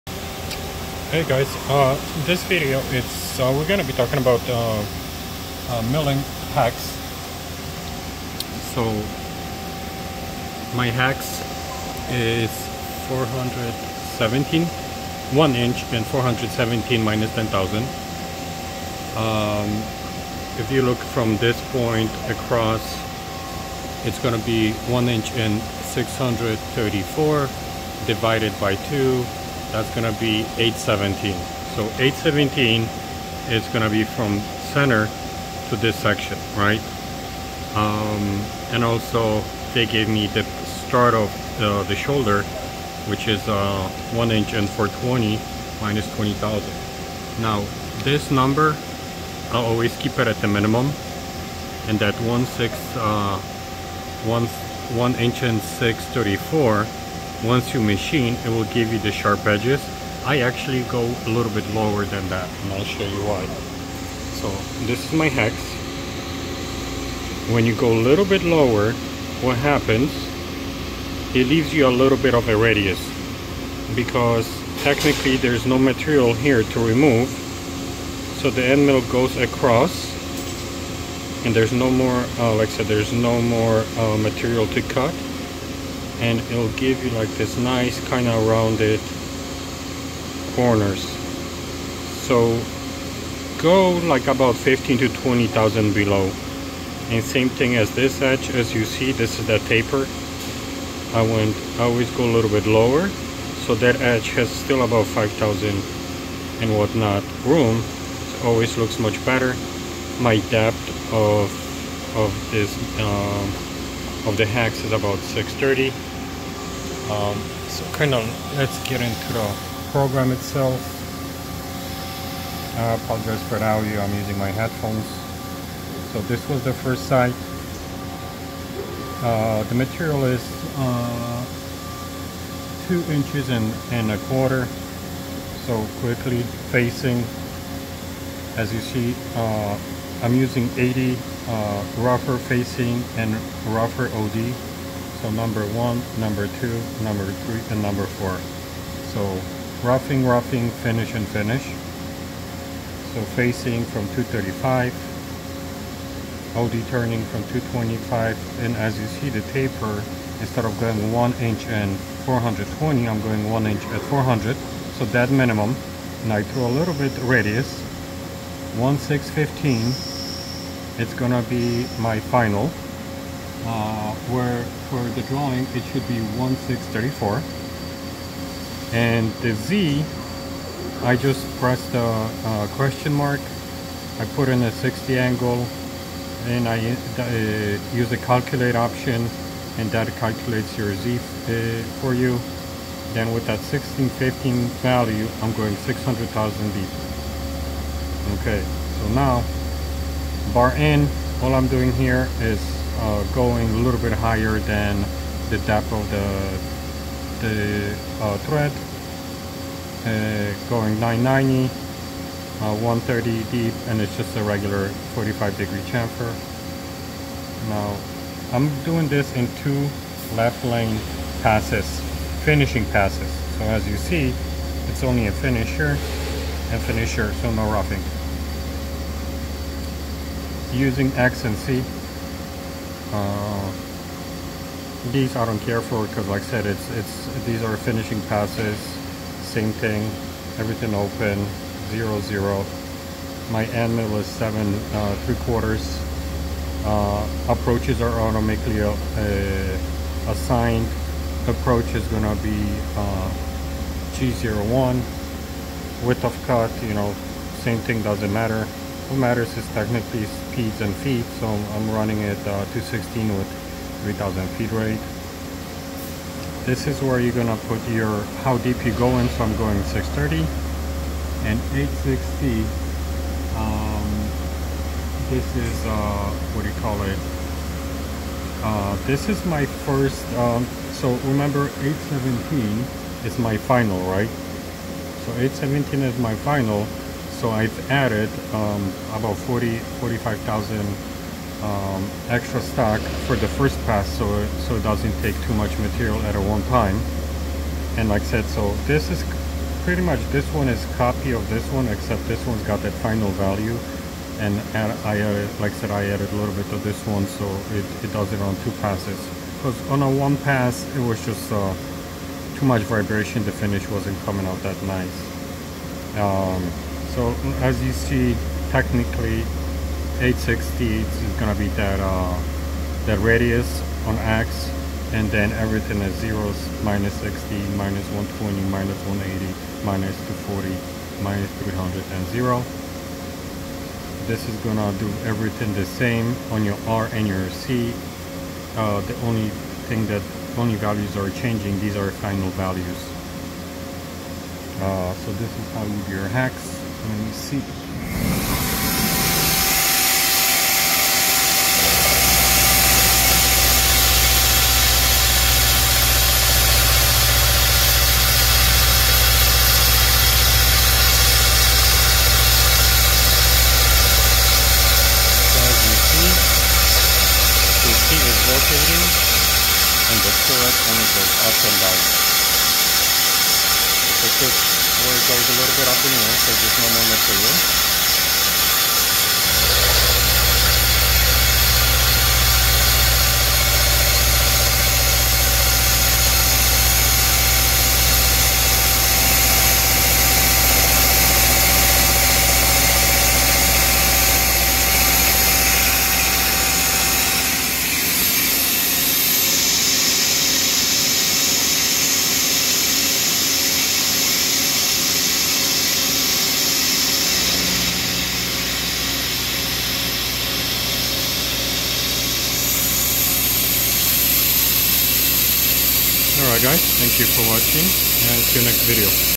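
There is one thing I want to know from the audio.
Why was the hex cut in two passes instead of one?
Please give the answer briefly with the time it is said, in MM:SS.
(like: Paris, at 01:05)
Too much vibration, at 05:12.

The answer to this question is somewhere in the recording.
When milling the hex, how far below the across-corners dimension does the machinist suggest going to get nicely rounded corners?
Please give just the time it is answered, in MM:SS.
01:34.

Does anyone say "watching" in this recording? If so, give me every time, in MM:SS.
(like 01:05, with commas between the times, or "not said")
06:57.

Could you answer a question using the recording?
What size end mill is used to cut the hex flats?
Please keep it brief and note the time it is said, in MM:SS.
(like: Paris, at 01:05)
3/4 inch, at 04:05.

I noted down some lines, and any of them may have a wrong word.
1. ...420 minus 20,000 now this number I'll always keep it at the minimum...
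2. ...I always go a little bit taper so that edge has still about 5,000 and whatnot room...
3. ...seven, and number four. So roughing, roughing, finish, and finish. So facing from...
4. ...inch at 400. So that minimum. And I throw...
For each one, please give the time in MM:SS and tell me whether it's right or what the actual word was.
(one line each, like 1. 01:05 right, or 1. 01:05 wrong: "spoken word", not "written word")
1. 00:44 right
2. 01:41 wrong: "lower", not "taper"
3. 02:27 wrong: "three", not "seven"
4. 02:43 right.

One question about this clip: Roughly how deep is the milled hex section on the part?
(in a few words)
630.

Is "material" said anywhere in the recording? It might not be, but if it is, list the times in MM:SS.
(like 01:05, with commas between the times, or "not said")
01:15, 01:24, 02:09, 04:55, 06:17.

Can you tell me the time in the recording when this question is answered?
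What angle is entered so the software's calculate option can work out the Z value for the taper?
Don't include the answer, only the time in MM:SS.
03:04.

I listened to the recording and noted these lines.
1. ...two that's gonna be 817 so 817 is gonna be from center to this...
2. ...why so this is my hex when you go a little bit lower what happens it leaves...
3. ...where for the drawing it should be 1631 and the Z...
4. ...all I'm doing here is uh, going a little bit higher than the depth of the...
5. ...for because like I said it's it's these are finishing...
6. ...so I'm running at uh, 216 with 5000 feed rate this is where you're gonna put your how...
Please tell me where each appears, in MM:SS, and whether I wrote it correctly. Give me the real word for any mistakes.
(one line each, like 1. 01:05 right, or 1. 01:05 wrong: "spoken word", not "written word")
1. 00:28 right
2. 01:03 right
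3. 02:54 wrong: "1634", not "1631"
4. 03:21 right
5. 03:55 right
6. 04:21 wrong: "3000", not "5000".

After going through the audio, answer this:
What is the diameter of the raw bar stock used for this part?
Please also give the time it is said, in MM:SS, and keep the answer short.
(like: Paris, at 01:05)
2 and a quarter inches, at 02:12.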